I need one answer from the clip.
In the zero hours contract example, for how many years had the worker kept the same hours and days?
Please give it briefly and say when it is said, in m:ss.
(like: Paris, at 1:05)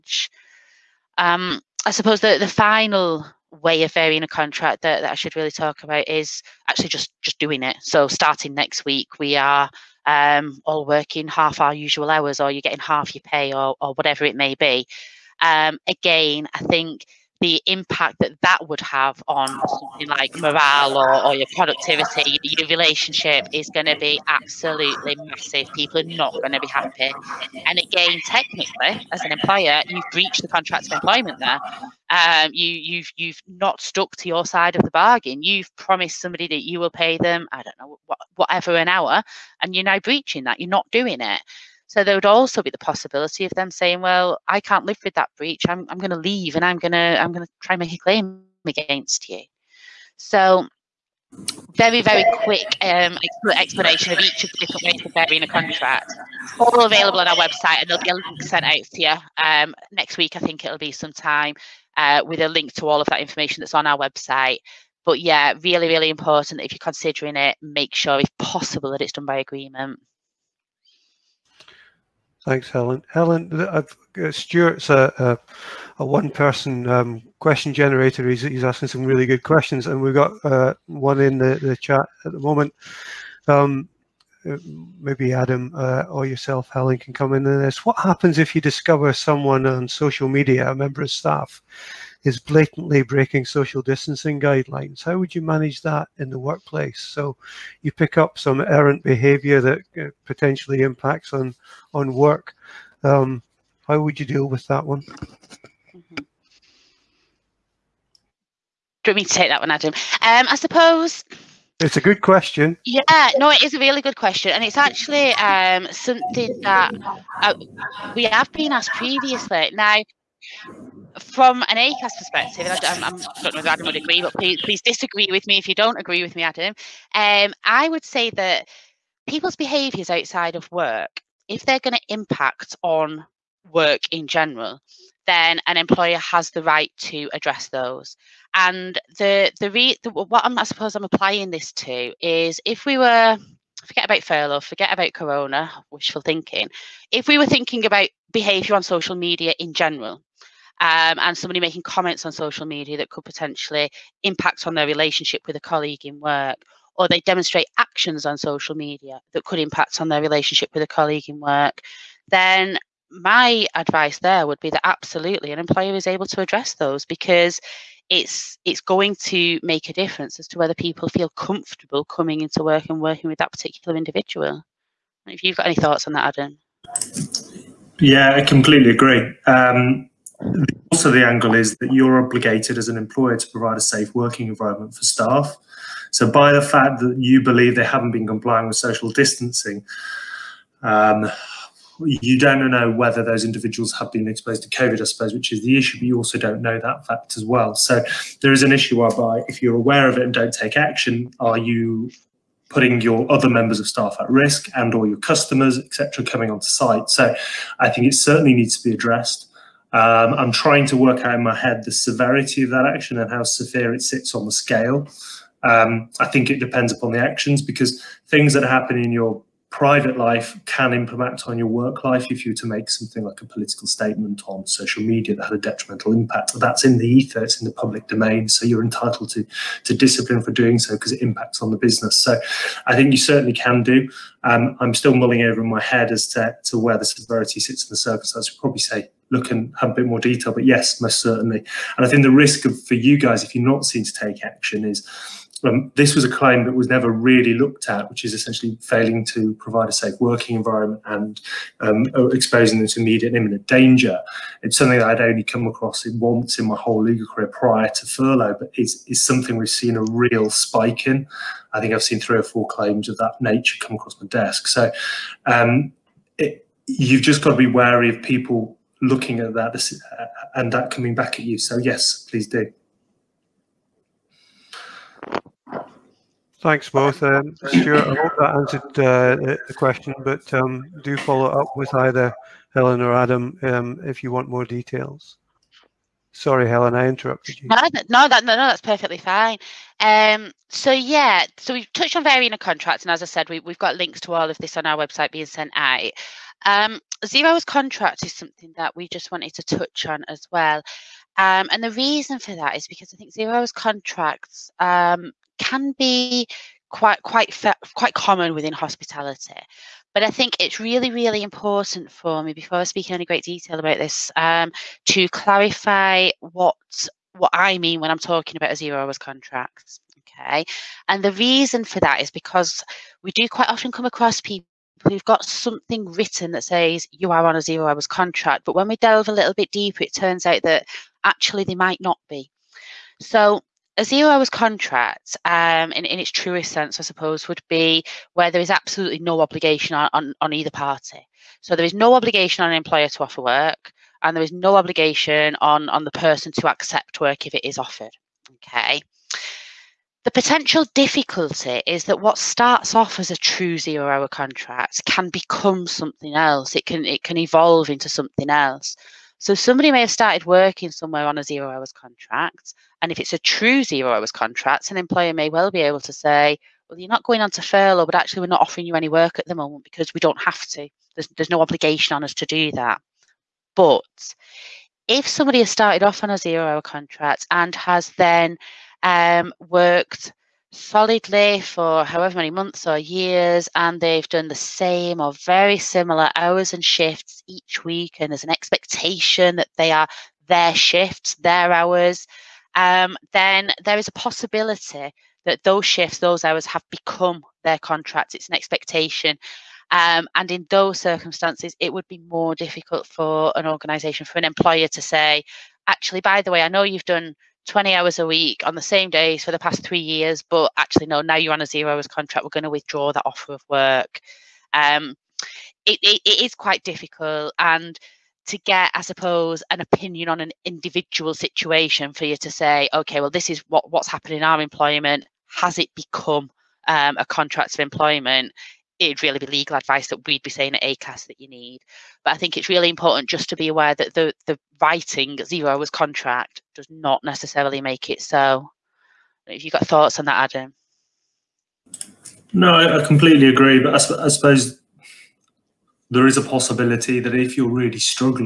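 three years, at 6:49.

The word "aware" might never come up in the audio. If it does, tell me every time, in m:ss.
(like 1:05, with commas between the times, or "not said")
3:19, 7:13.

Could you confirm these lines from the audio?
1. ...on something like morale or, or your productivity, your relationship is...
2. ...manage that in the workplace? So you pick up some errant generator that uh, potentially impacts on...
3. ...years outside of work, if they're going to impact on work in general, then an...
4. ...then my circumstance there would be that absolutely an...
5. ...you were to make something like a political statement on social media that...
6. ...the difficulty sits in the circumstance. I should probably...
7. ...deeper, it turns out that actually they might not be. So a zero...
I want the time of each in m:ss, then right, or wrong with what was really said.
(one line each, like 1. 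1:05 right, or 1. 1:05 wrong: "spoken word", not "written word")
1. 0:19 right
2. 1:35 wrong: "behavior", not "generator"
3. 2:09 wrong: "behaviours", not "years"
4. 2:42 wrong: "advice", not "circumstance"
5. 3:42 right
6. 3:56 wrong: "severity", not "difficulty"
7. 5:29 right.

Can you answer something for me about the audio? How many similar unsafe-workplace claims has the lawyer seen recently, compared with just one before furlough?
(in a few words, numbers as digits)
three or four.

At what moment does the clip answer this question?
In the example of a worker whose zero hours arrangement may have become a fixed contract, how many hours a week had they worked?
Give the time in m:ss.
6:47.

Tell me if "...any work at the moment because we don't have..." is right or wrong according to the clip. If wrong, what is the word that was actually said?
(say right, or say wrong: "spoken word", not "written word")
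right.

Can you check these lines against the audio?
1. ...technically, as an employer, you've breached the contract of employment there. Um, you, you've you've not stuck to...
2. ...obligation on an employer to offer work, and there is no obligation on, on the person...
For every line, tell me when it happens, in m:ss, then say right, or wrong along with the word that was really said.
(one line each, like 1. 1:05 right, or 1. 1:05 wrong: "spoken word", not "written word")
1. 0:28 right
2. 5:42 right.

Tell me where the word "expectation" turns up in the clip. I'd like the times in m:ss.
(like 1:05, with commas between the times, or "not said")
6:28, 6:38.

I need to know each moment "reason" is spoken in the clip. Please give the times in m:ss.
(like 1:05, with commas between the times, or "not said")
5:01, 5:21.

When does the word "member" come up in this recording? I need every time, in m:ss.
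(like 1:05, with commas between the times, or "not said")
1:30, 3:23.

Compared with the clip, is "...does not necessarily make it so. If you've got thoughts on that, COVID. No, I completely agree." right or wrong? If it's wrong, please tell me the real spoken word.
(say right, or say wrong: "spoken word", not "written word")
wrong: "Adam", not "COVID".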